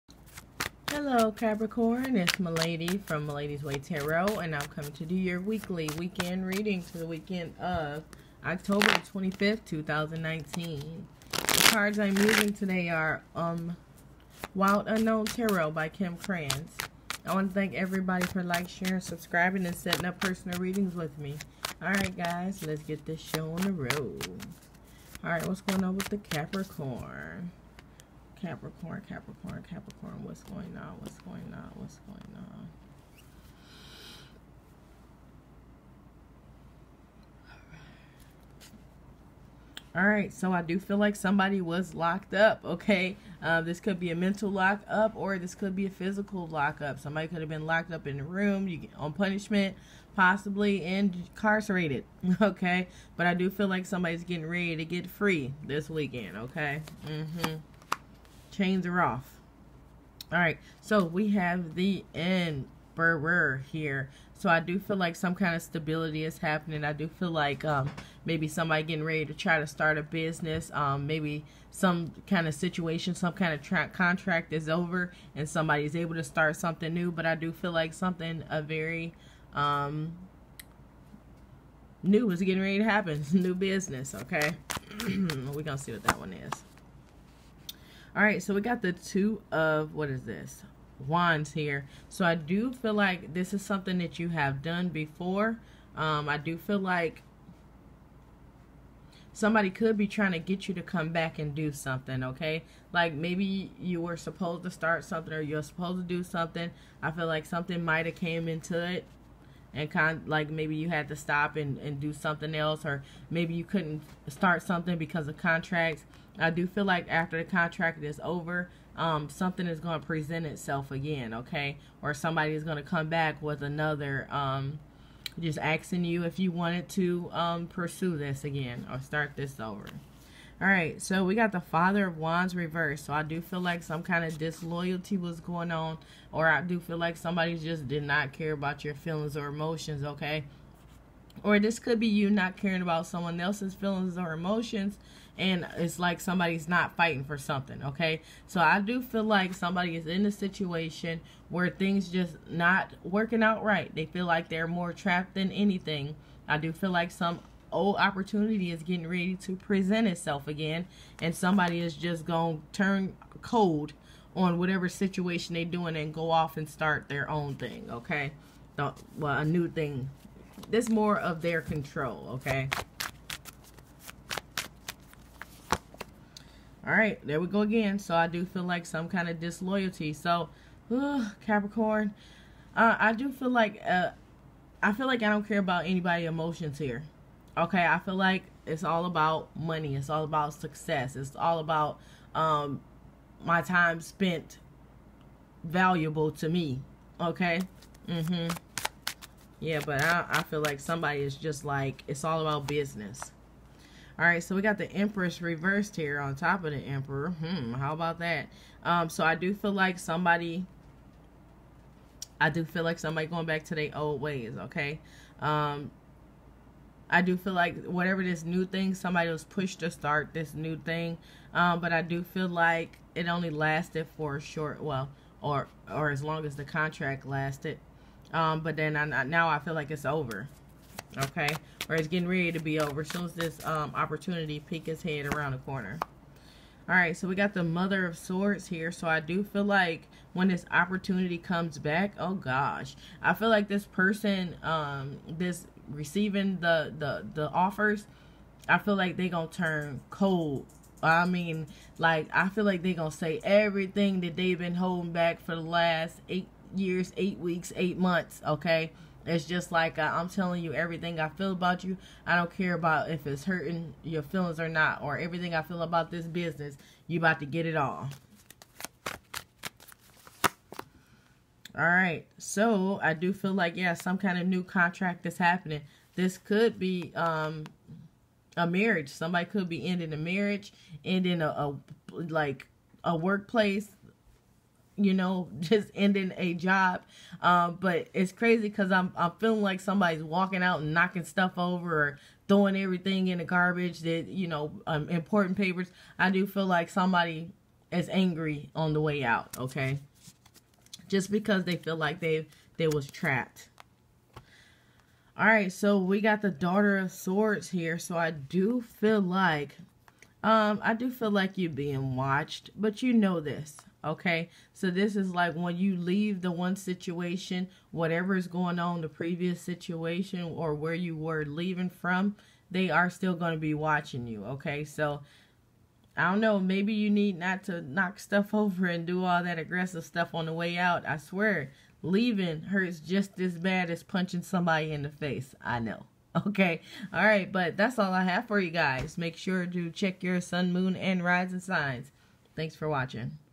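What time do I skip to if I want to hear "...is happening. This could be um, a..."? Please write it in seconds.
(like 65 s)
275 s.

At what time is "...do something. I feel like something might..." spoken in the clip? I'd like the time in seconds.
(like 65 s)
106 s.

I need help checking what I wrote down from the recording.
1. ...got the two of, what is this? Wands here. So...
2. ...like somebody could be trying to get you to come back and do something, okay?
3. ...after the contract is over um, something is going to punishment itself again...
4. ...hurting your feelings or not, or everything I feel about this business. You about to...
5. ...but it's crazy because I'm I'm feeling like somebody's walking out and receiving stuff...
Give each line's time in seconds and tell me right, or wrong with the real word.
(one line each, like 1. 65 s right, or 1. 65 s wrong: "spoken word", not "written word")
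1. 88 s right
2. 96 s right
3. 117 s wrong: "present", not "punishment"
4. 263 s right
5. 287 s wrong: "knocking", not "receiving".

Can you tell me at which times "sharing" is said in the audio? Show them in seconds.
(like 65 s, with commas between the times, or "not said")
18 s.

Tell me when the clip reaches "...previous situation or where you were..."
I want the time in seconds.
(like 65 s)
319 s.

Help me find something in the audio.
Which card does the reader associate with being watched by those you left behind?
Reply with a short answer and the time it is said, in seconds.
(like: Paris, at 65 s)
Daughter of Swords, at 306 s.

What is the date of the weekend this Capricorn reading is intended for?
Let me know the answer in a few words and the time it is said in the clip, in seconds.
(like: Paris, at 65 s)
October 25th, 2019, at 8 s.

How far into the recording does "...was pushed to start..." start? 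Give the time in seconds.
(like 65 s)
219 s.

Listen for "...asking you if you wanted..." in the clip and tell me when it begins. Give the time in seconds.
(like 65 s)
125 s.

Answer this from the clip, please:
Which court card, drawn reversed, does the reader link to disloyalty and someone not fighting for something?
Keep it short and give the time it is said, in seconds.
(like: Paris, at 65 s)
Father of Wands, at 131 s.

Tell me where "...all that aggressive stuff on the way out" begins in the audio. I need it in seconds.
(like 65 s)
329 s.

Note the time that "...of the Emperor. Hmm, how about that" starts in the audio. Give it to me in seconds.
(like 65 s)
206 s.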